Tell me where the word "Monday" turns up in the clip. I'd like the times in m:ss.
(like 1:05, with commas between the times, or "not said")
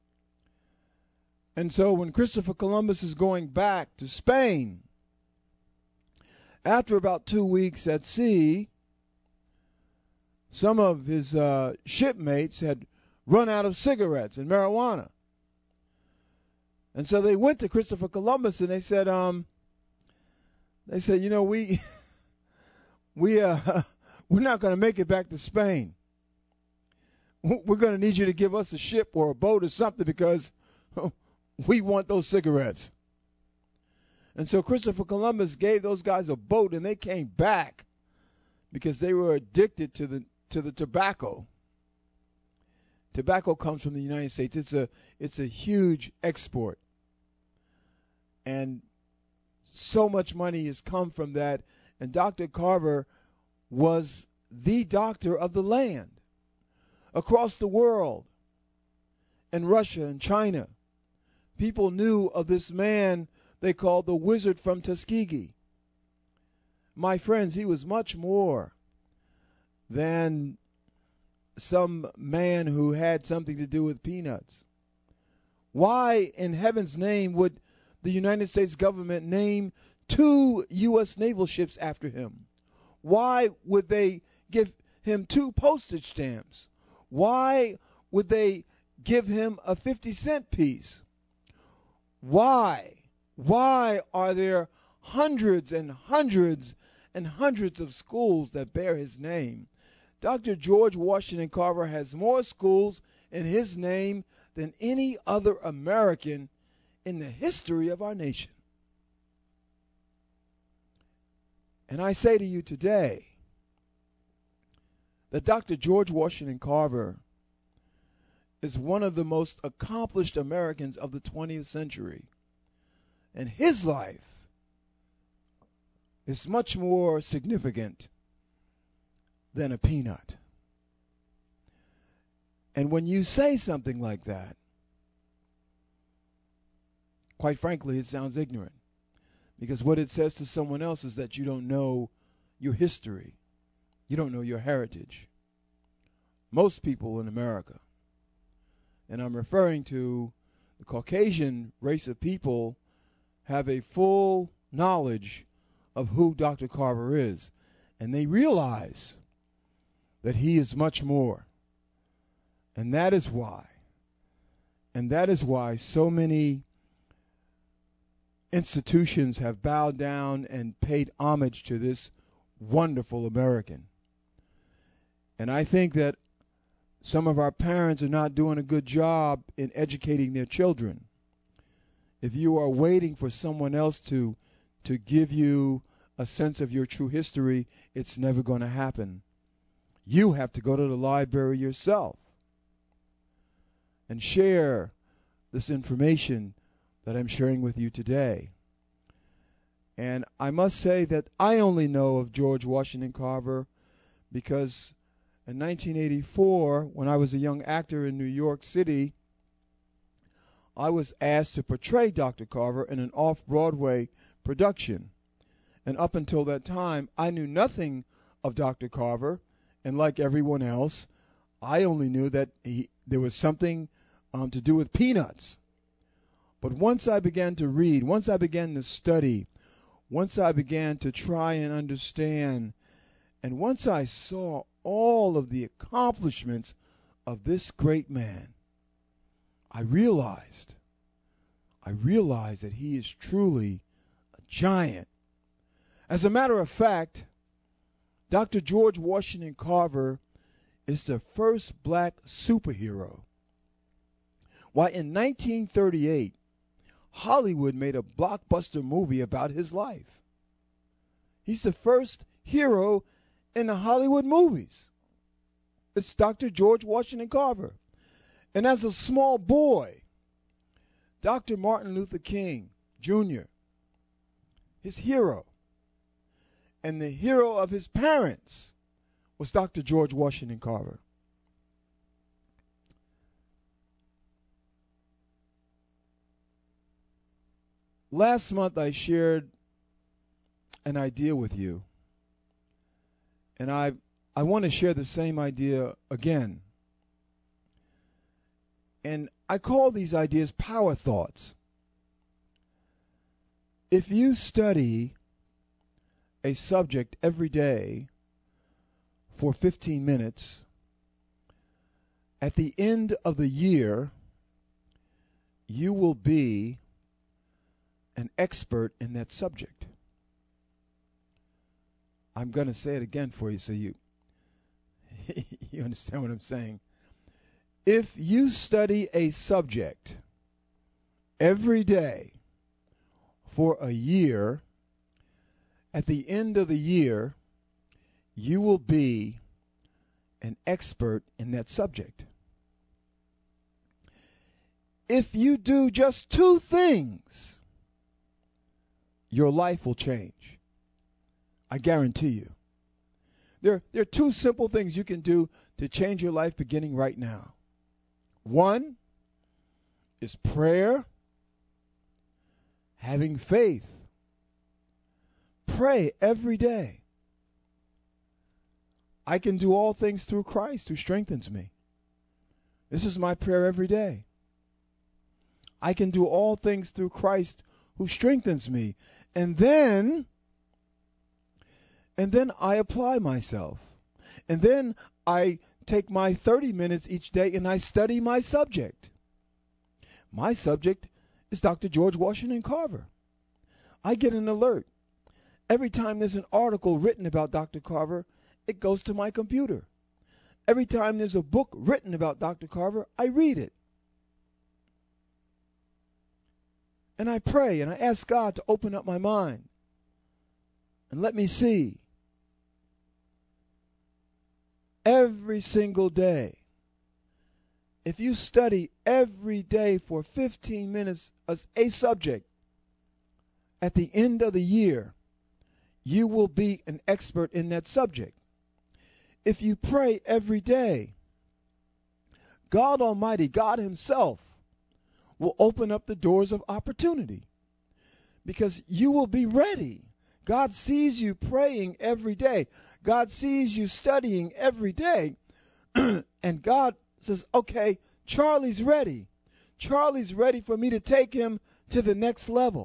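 not said.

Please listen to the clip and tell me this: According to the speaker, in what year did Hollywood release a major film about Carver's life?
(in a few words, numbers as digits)
1938.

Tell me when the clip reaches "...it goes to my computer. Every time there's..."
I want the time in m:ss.
6:38.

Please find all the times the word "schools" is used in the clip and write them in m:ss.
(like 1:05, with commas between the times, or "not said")
1:37, 1:42.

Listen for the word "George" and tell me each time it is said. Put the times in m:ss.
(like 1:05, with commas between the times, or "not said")
1:40, 1:55, 3:22, 4:08, 4:26, 4:39, 6:31.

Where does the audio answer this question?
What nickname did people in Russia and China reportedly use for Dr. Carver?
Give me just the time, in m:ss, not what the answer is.
1:04.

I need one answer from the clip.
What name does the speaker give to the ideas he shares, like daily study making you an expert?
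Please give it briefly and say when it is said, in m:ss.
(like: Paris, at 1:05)
Power thoughts, at 5:00.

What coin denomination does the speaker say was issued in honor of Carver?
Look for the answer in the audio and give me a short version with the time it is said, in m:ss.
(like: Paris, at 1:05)
50 cent piece, at 1:29.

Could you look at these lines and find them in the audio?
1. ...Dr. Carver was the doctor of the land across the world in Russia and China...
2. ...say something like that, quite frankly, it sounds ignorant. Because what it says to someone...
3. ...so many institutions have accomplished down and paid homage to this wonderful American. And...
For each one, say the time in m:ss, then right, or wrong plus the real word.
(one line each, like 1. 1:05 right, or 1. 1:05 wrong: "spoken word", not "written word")
1. 0:52 right
2. 2:13 right
3. 2:45 wrong: "bowed", not "accomplished".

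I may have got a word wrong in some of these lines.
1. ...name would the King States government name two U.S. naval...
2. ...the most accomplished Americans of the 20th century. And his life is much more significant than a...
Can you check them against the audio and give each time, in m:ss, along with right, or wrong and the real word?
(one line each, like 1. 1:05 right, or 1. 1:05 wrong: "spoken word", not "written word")
1. 1:16 wrong: "United", not "King"
2. 1:59 right.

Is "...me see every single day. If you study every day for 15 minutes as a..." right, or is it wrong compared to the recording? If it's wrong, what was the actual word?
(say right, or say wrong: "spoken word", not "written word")
right.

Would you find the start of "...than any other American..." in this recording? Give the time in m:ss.
1:44.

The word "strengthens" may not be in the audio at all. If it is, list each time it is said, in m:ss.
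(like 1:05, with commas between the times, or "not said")
6:10, 6:18.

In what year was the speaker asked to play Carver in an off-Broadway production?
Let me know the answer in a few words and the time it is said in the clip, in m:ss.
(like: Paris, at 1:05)
1984, at 3:25.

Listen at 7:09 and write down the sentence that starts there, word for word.
If you pray every day, God Almighty, God Himself, will open up the doors of opportunity because you will be ready.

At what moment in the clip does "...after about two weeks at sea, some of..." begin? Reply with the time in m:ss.
0:06.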